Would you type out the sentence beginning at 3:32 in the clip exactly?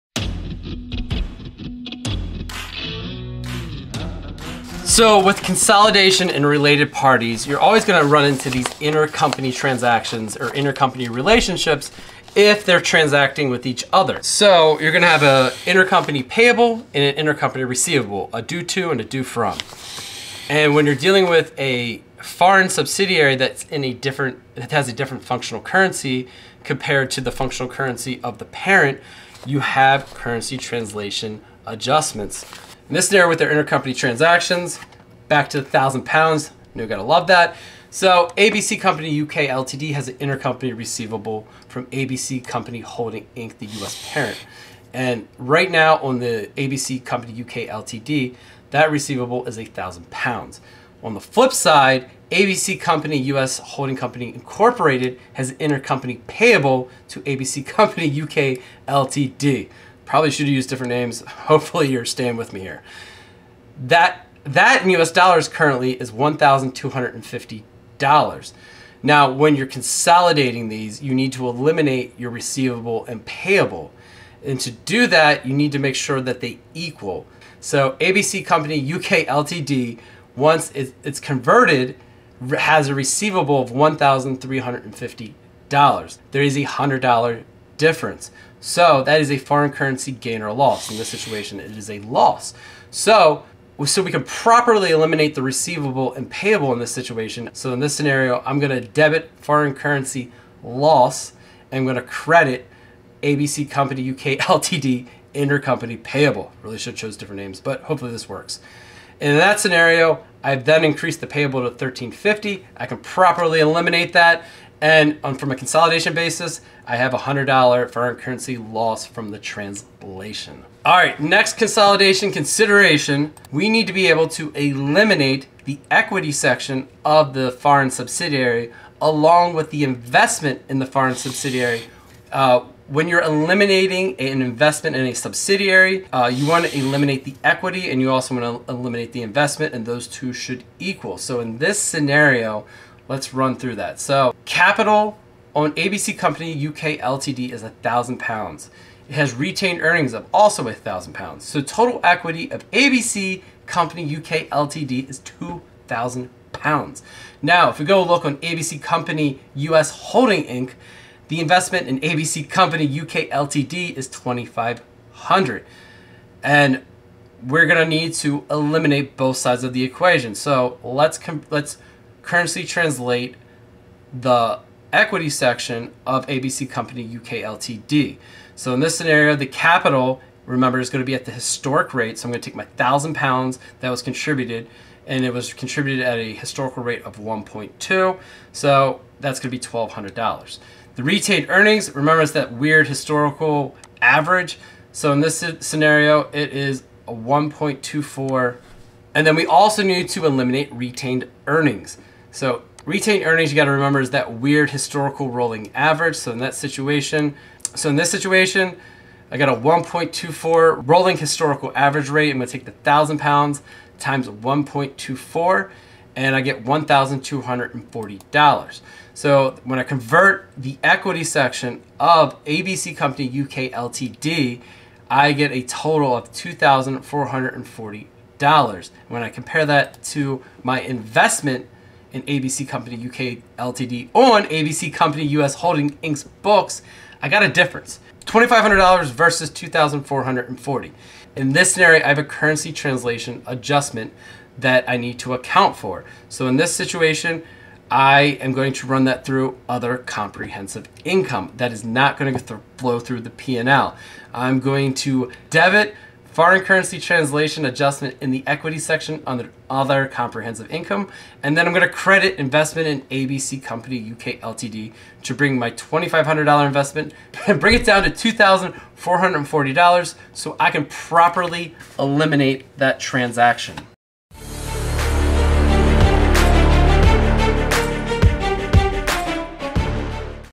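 I'm gonna take the thousand pounds times 1.24 and I get $1,240.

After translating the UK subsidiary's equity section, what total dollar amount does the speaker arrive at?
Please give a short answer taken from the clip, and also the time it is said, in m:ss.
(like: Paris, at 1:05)
2440 dollars, at 3:46.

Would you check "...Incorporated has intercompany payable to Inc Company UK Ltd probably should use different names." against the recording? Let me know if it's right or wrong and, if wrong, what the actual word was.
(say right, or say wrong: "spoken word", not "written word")
wrong: "ABC", not "Inc".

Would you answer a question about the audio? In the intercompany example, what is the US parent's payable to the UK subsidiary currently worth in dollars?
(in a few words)
$1,250.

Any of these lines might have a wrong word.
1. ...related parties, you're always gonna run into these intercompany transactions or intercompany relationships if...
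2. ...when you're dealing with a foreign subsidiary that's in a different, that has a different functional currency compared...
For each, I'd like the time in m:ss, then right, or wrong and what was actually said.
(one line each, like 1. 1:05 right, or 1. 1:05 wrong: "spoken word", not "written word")
1. 0:06 right
2. 0:20 right.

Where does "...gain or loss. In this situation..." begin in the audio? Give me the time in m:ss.
1:30.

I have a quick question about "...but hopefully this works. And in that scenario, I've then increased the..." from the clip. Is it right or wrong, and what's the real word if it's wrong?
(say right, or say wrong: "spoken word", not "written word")
right.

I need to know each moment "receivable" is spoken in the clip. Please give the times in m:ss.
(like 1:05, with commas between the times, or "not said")
0:17, 0:40, 0:48, 1:12, 1:22, 1:35.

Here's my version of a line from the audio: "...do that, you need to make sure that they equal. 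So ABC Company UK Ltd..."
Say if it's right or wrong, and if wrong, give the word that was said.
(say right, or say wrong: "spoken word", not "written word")
right.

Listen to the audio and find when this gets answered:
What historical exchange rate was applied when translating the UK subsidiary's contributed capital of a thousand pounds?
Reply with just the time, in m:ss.
3:07.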